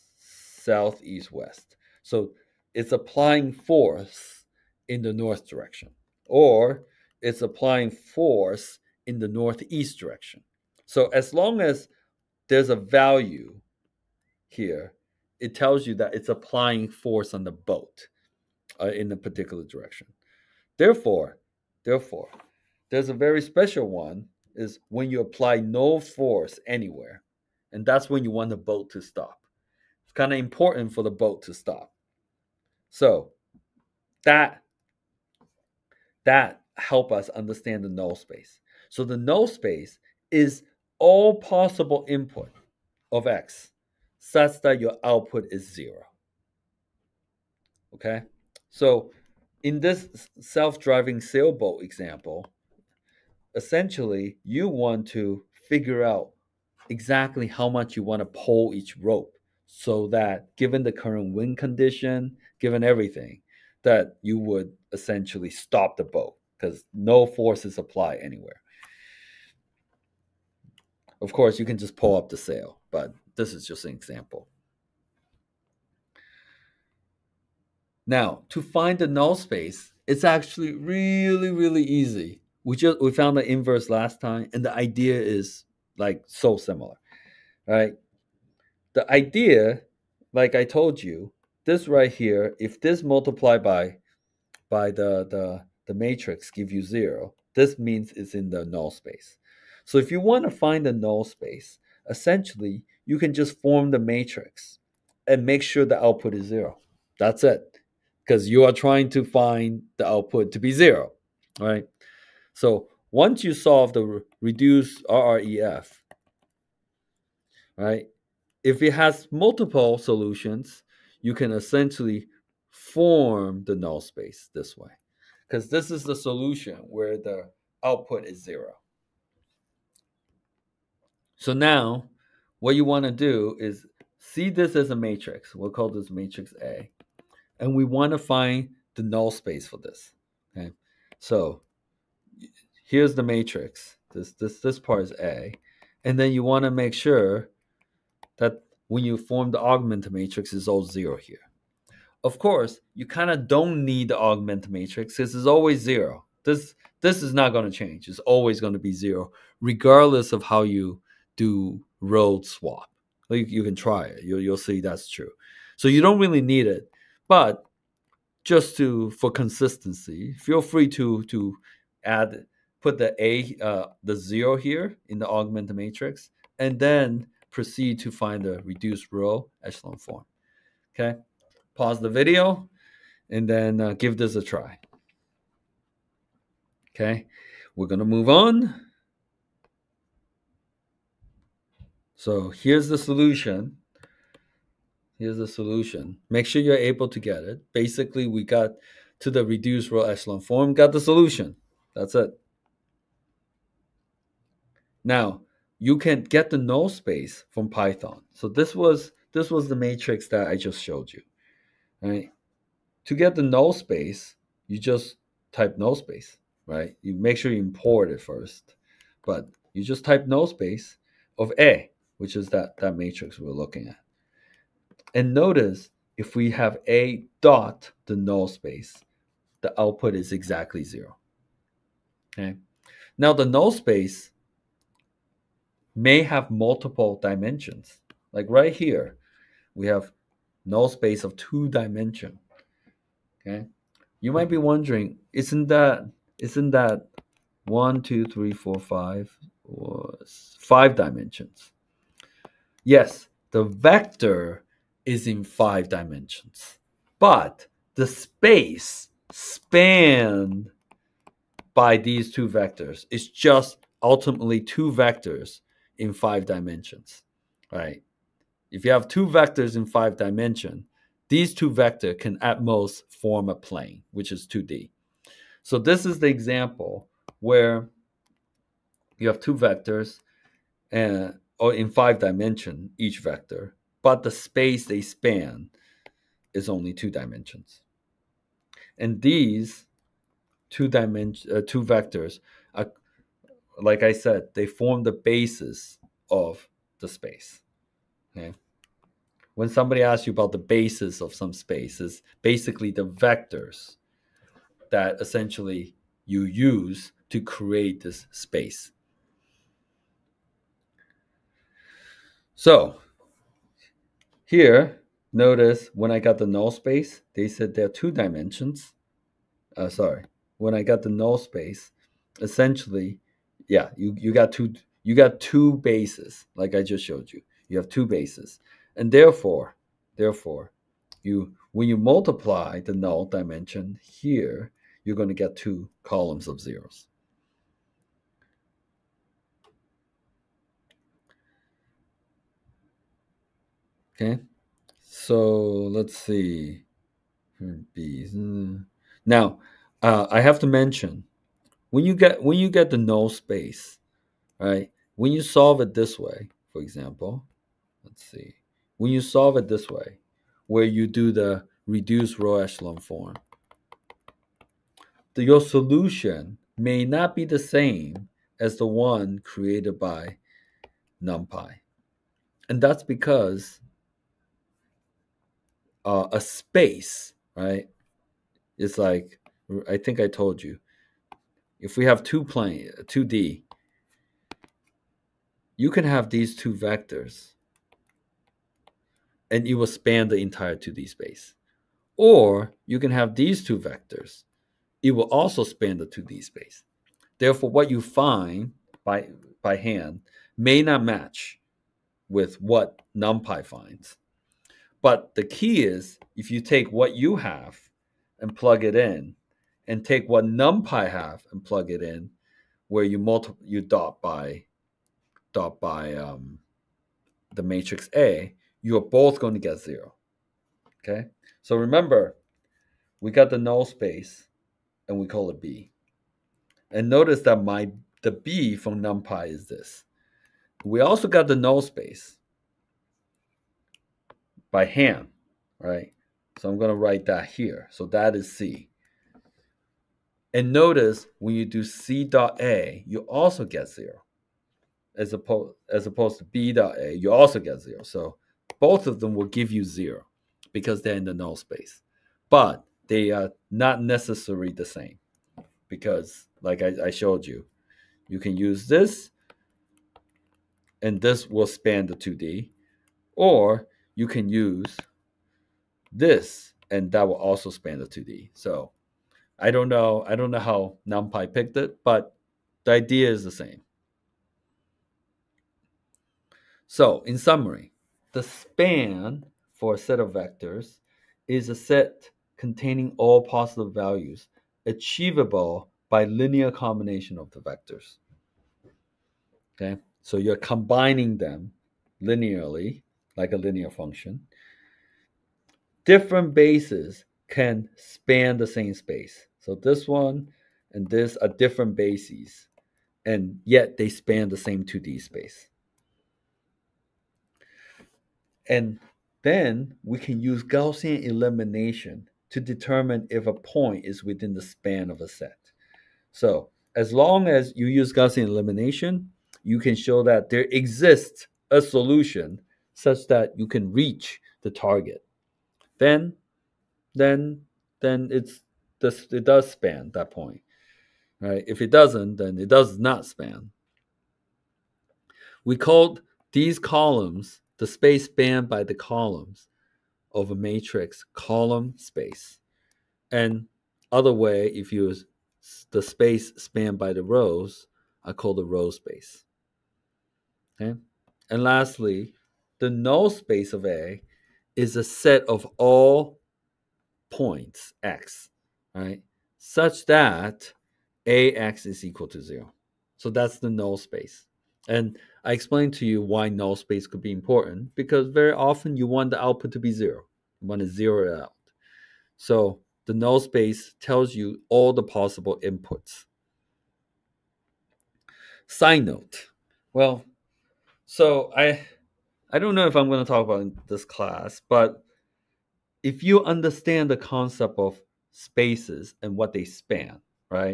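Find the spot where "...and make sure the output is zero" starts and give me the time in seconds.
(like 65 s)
105 s.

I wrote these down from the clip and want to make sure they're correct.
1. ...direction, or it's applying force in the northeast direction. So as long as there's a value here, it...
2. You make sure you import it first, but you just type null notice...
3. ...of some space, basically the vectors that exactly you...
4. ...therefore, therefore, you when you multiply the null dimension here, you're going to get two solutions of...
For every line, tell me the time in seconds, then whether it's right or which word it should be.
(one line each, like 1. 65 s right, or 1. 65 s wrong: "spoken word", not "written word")
1. 5 s right
2. 217 s wrong: "space", not "notice"
3. 301 s wrong: "essentially", not "exactly"
4. 329 s wrong: "columns", not "solutions".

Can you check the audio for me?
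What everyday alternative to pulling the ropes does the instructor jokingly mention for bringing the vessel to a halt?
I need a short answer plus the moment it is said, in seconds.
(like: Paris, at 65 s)
pull up the sail, at 71 s.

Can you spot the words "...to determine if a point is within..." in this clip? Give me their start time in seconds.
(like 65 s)
512 s.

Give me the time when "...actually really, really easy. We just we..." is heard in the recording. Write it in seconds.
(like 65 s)
80 s.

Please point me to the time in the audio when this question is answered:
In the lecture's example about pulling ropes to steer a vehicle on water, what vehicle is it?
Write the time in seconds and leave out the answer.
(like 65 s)
50 s.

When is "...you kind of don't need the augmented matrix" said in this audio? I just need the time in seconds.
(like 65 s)
152 s.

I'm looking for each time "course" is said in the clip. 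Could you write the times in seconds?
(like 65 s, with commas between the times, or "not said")
71 s, 152 s.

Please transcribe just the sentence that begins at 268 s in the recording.
If you have two vectors in five dimension, these two vector can at most form a plane, which is 2D.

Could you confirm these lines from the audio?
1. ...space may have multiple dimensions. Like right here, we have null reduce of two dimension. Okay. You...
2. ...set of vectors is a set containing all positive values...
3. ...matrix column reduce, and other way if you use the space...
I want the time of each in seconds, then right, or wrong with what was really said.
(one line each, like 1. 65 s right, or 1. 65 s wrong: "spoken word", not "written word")
1. 233 s wrong: "space", not "reduce"
2. 479 s right
3. 540 s wrong: "space", not "reduce".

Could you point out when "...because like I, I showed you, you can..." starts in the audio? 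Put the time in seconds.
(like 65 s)
455 s.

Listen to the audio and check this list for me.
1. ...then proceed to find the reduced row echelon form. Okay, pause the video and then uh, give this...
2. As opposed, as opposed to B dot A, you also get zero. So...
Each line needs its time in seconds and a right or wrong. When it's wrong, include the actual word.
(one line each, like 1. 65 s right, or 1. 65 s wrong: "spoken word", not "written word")
1. 176 s right
2. 445 s right.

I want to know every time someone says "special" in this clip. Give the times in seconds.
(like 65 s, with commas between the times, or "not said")
23 s.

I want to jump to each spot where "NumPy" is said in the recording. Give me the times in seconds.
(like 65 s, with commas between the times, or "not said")
371 s, 403 s, 410 s, 429 s, 471 s.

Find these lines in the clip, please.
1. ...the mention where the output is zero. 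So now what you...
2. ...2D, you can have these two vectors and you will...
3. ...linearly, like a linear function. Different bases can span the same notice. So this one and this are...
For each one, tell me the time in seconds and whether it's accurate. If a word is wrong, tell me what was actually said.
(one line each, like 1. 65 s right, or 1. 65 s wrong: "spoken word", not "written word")
1. 126 s wrong: "solution", not "mention"
2. 383 s right
3. 492 s wrong: "space", not "notice".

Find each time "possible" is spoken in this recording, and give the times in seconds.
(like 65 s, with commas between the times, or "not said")
41 s, 575 s.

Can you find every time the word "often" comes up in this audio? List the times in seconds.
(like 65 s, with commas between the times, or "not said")
568 s.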